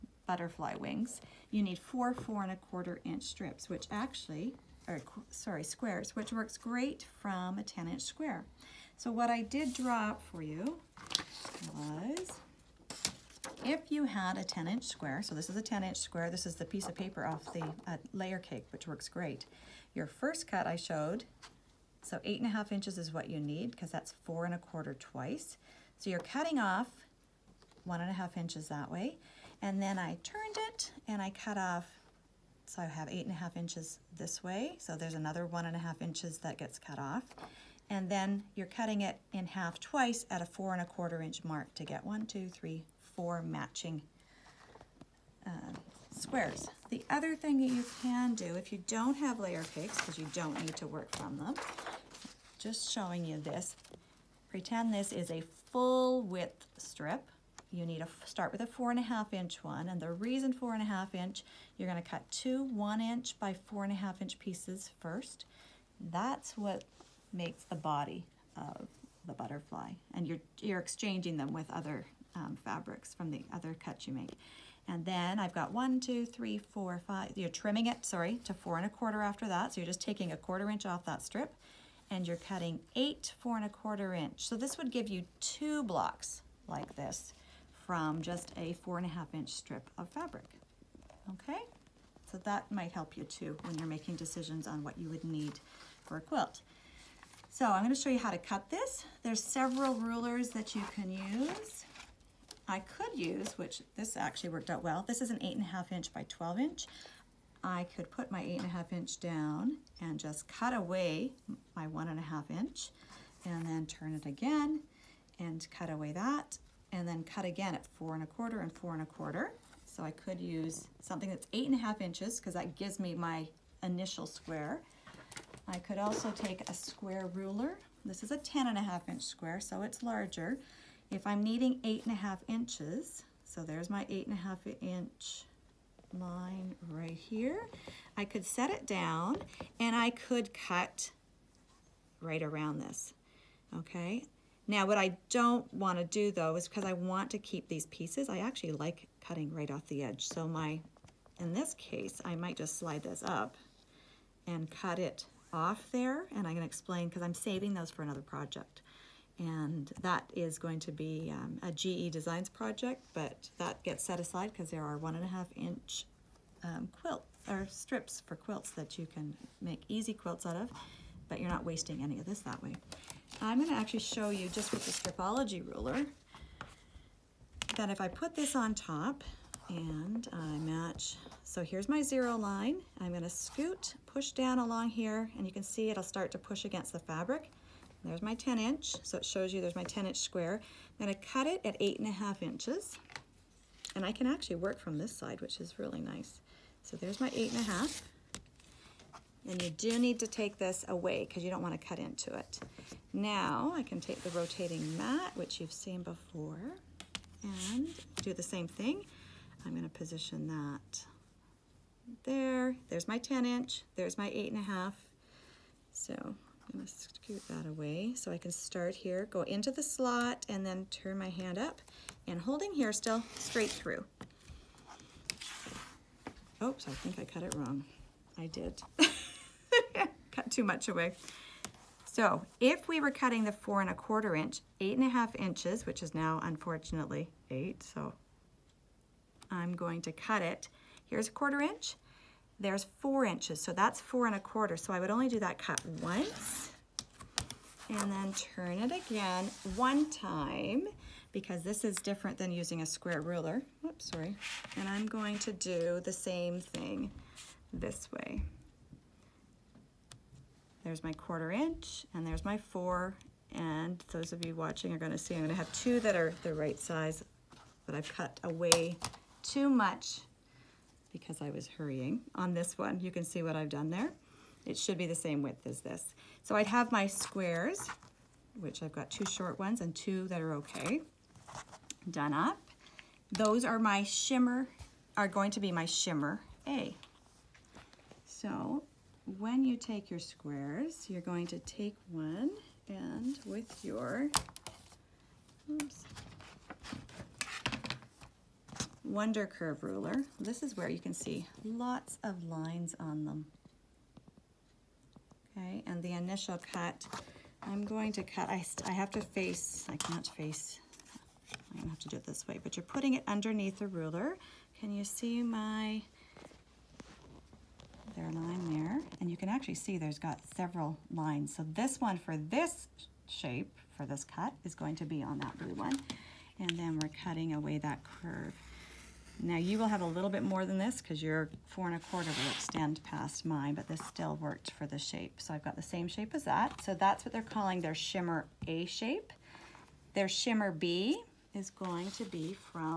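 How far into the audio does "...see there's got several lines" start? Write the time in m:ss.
5:19.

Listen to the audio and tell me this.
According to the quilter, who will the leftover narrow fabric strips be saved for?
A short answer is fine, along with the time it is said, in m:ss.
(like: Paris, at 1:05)
GE Designs, at 2:41.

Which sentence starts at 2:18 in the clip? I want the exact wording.
I could set it down and I could cut right around this, okay?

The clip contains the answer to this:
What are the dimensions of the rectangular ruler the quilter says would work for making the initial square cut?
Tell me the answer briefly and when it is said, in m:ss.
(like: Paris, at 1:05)
8 1/2 inch by 12 inch, at 1:45.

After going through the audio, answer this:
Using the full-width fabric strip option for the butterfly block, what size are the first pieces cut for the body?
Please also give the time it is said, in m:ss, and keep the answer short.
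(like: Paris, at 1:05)
1 inch by 4 1/2 inch, at 1:02.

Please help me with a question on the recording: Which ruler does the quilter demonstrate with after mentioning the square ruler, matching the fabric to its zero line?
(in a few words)
Stripology ruler.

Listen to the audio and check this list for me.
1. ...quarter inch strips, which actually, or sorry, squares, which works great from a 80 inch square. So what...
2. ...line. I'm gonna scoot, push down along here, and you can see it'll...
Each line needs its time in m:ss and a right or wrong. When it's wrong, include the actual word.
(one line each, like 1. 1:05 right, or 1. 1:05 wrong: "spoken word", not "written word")
1. 0:02 wrong: "10", not "80"
2. 3:02 right.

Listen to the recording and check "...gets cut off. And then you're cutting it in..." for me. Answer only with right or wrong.
right.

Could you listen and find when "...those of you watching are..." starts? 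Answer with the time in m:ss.
4:24.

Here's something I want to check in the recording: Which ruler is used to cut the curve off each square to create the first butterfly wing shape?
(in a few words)
Wonder Curve Ruler.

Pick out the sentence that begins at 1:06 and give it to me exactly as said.
That's what makes the body of the butterfly.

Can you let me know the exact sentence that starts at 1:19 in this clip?
So you're just taking a quarter inch off that strip and you're cutting eight four and a quarter inch.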